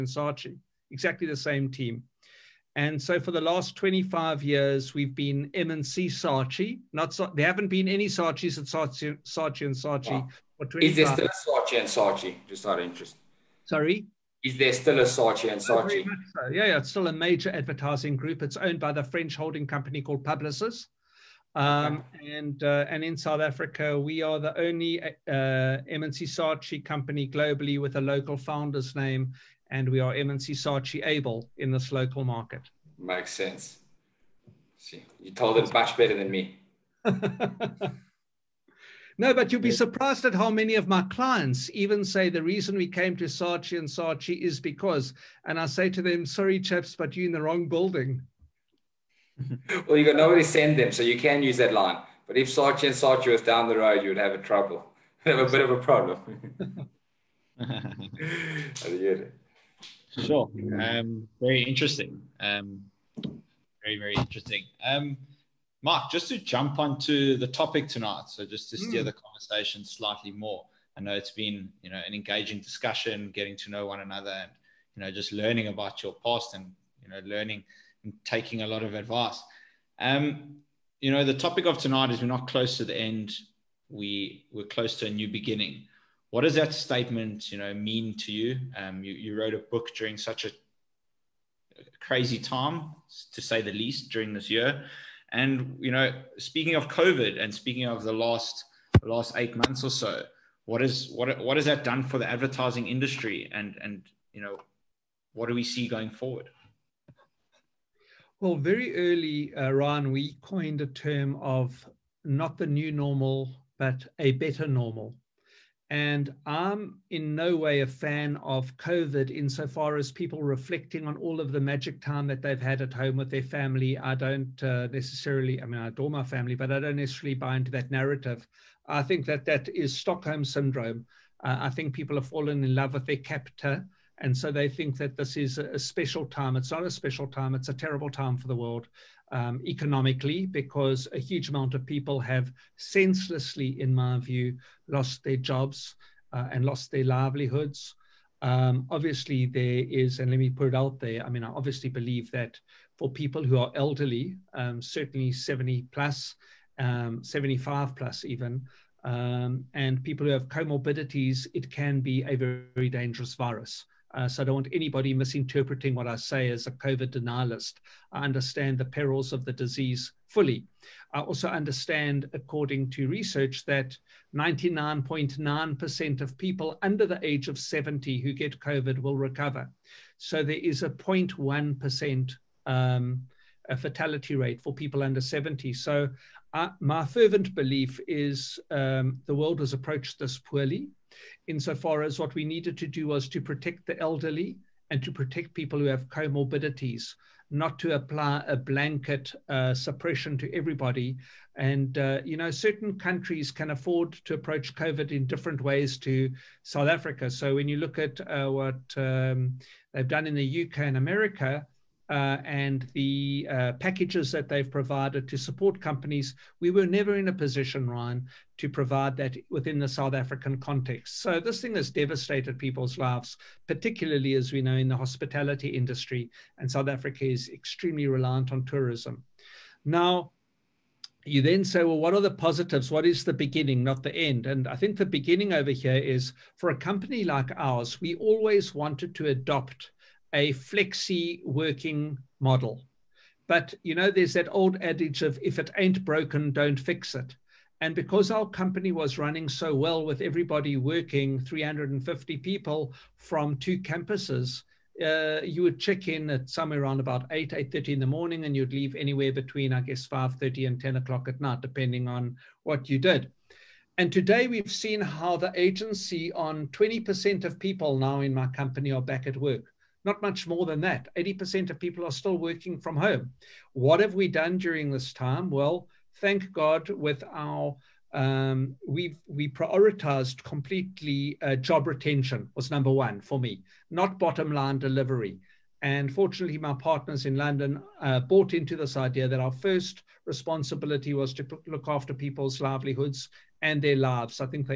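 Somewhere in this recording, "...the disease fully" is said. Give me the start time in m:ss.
2:49.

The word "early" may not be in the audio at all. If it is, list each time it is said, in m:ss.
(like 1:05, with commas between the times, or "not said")
1:48.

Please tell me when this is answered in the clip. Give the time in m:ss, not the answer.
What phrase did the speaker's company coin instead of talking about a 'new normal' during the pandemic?
1:54.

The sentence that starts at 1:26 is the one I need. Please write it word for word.
What does that statement, you know, mean to you?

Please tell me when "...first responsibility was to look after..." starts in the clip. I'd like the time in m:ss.
4:49.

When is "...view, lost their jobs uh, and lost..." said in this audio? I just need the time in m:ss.
2:24.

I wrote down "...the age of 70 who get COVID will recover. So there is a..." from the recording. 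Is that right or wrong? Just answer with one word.
right.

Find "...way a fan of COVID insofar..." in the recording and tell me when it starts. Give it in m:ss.
1:57.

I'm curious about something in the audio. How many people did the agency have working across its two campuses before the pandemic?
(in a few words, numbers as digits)
350.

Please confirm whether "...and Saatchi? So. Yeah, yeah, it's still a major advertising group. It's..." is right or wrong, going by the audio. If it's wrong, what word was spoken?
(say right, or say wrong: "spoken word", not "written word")
right.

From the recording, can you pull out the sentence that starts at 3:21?
And, uh, you know, certain countries can afford to approach COVID in different ways to South Africa.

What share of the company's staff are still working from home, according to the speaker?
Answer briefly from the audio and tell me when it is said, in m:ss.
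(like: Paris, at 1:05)
80%, at 4:31.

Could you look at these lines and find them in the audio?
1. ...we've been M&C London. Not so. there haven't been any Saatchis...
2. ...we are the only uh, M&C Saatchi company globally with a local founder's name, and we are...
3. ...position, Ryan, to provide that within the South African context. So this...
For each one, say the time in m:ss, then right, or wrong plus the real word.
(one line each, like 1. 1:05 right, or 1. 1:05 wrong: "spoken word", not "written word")
1. 0:04 wrong: "Saatchi", not "London"
2. 0:23 right
3. 3:37 right.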